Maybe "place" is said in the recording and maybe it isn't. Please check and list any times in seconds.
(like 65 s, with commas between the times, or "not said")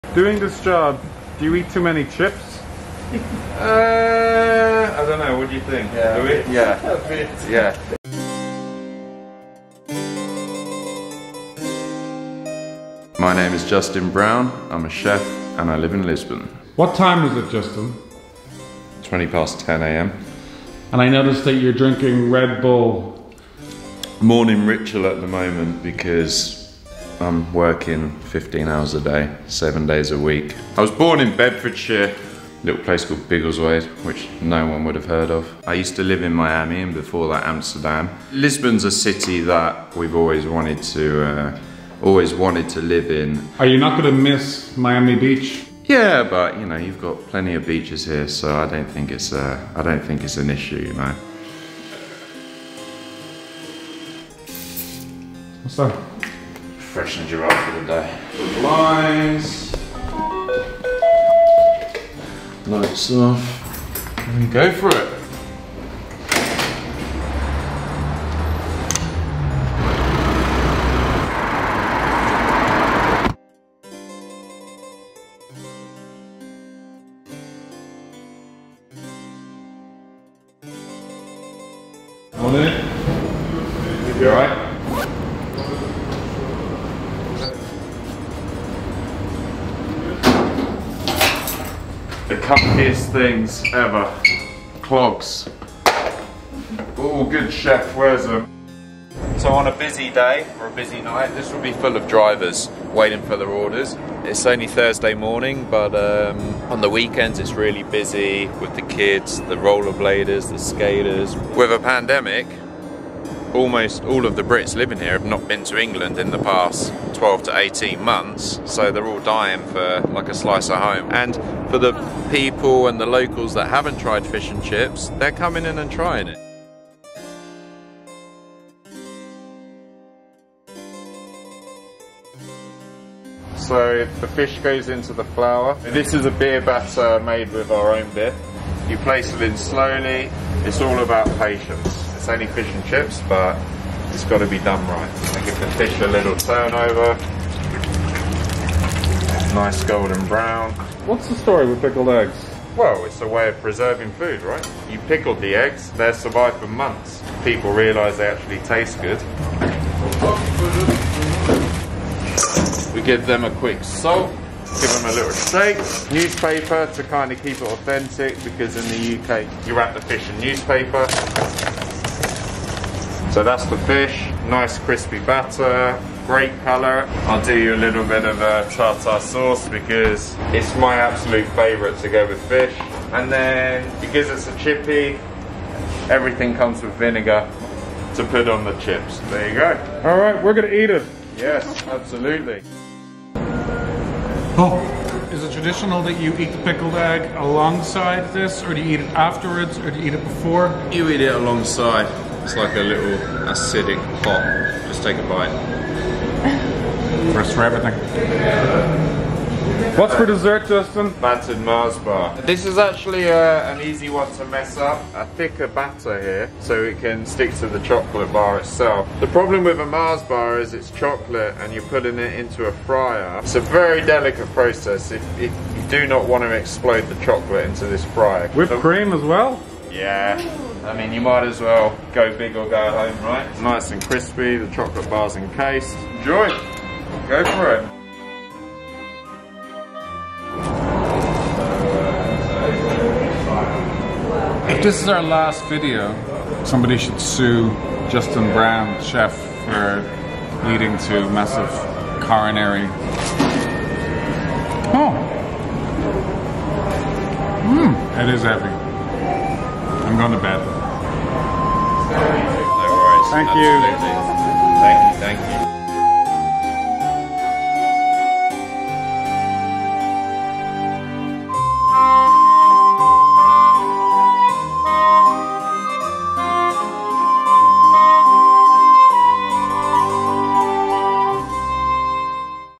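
32 s, 138 s.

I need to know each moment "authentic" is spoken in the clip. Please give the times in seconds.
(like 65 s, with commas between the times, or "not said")
167 s.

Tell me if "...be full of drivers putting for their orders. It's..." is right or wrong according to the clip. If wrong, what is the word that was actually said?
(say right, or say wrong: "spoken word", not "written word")
wrong: "waiting", not "putting".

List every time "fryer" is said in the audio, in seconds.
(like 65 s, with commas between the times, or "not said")
222 s, 228 s.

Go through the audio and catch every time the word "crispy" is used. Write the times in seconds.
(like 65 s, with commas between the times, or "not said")
174 s, 234 s.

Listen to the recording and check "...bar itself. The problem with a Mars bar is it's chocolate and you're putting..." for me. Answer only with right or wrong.
right.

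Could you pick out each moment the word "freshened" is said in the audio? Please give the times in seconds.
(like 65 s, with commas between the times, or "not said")
56 s.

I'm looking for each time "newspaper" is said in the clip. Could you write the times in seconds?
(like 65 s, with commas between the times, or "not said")
166 s, 170 s.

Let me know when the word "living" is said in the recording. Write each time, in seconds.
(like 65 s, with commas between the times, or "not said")
114 s.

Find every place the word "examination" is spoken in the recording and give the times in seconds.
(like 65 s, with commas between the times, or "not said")
not said.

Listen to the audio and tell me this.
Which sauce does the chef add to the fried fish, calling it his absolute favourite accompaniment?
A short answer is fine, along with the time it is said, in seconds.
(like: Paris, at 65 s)
Tartar sauce, at 178 s.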